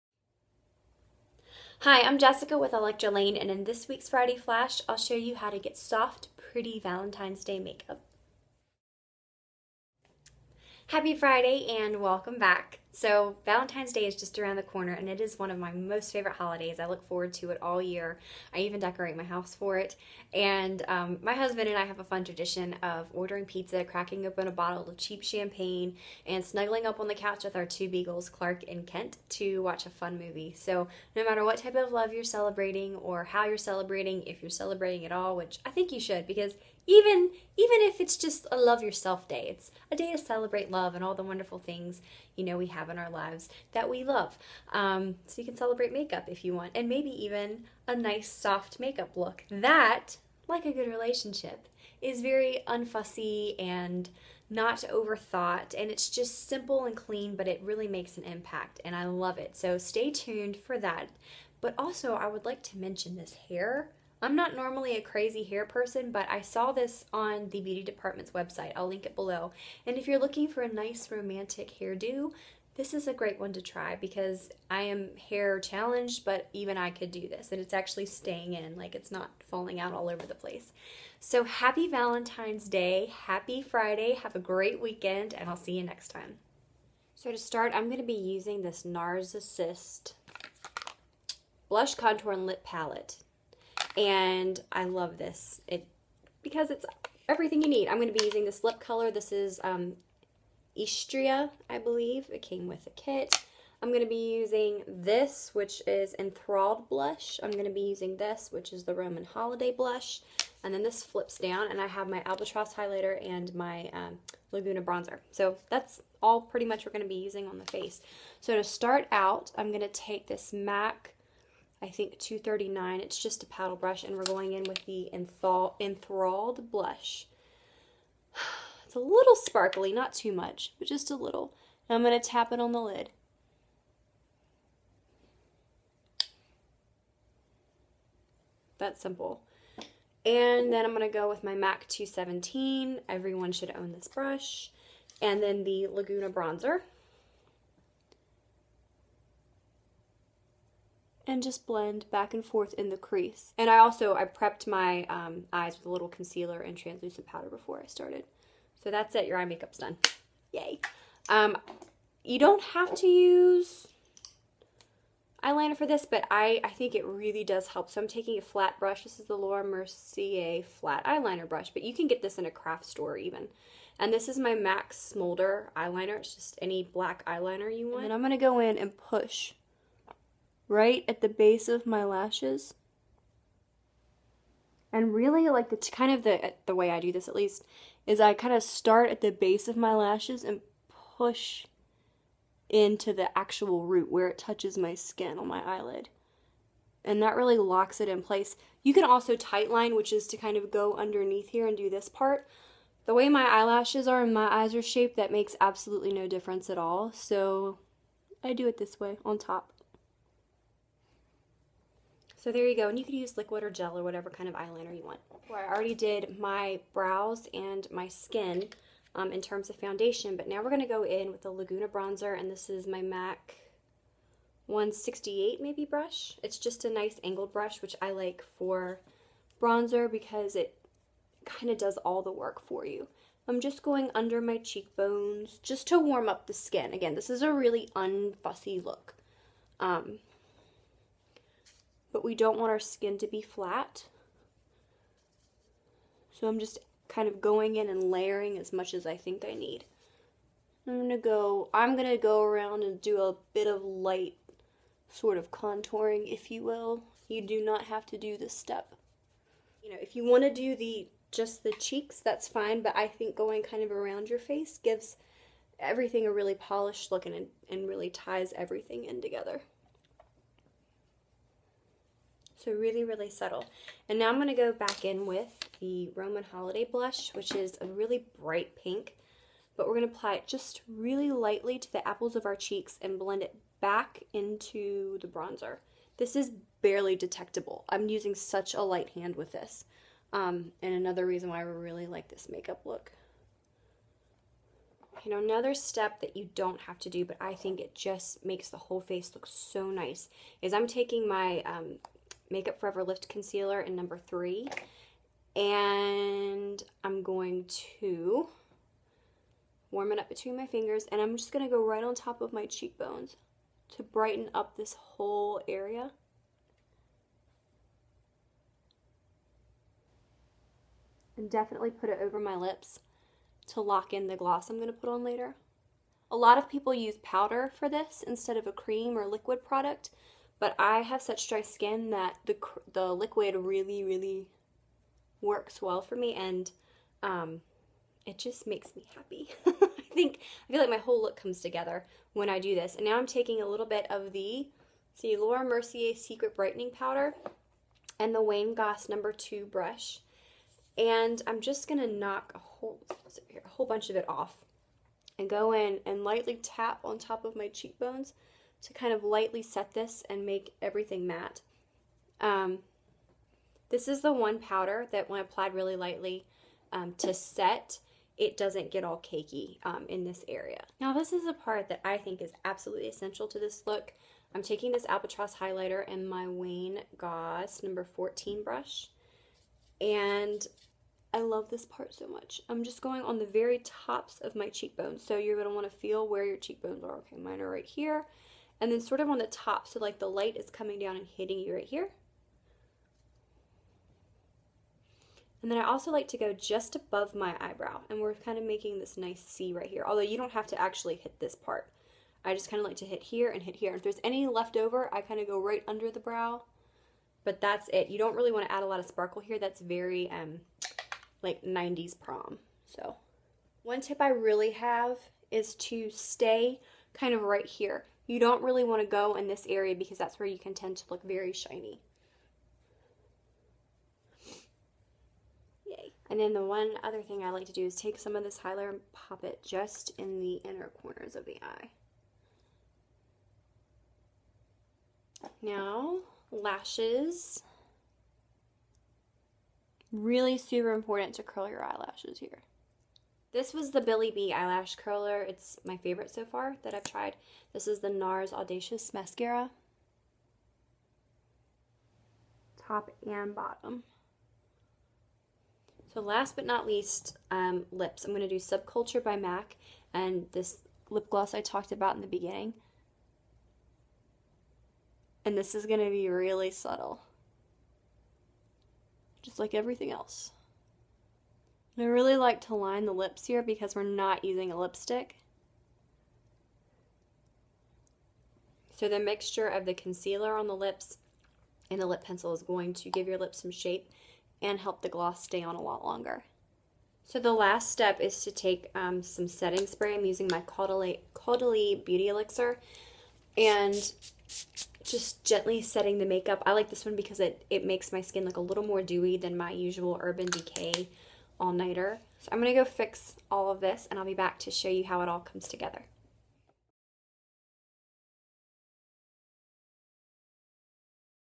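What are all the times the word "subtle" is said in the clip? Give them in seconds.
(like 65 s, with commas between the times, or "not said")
273 s, 466 s.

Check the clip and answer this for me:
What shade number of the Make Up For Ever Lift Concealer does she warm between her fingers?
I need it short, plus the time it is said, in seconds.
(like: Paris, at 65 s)
3, at 303 s.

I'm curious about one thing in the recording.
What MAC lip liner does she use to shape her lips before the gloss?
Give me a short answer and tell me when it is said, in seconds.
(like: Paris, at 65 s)
Subculture, at 458 s.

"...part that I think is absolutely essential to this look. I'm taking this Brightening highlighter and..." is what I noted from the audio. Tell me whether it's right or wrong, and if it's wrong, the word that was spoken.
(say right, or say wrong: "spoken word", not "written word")
wrong: "Albatross", not "Brightening".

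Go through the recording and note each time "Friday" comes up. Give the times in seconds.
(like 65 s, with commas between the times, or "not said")
4 s, 11 s, 83 s.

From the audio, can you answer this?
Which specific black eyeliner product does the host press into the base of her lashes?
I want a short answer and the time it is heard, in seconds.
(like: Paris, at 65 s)
MAC Smolder, at 174 s.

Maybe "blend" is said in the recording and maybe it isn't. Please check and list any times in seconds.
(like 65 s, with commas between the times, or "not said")
151 s, 283 s.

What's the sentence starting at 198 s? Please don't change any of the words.
You can also tightline, which is to kind of go underneath here and do this part.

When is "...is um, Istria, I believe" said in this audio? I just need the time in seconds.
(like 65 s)
99 s.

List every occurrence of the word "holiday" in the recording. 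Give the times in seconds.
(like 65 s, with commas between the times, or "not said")
16 s, 109 s, 276 s.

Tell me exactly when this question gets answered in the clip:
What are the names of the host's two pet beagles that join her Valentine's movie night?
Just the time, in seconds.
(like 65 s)
28 s.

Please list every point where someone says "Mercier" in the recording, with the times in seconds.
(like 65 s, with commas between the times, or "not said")
169 s, 345 s.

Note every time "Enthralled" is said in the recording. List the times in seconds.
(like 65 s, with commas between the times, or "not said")
106 s, 125 s.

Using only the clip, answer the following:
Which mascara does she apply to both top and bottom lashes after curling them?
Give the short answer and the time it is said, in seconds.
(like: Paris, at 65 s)
NARS Audacious, at 448 s.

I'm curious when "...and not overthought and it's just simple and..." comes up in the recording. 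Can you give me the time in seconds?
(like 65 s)
53 s.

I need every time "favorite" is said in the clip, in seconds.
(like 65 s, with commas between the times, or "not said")
16 s, 445 s.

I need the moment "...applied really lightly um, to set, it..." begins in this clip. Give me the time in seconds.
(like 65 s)
365 s.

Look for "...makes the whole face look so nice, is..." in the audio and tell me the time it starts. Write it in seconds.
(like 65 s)
298 s.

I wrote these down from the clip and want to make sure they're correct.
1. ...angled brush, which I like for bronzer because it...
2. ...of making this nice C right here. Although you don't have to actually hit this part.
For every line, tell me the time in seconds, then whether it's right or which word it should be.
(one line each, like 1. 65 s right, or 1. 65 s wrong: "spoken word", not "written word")
1. 227 s right
2. 398 s right.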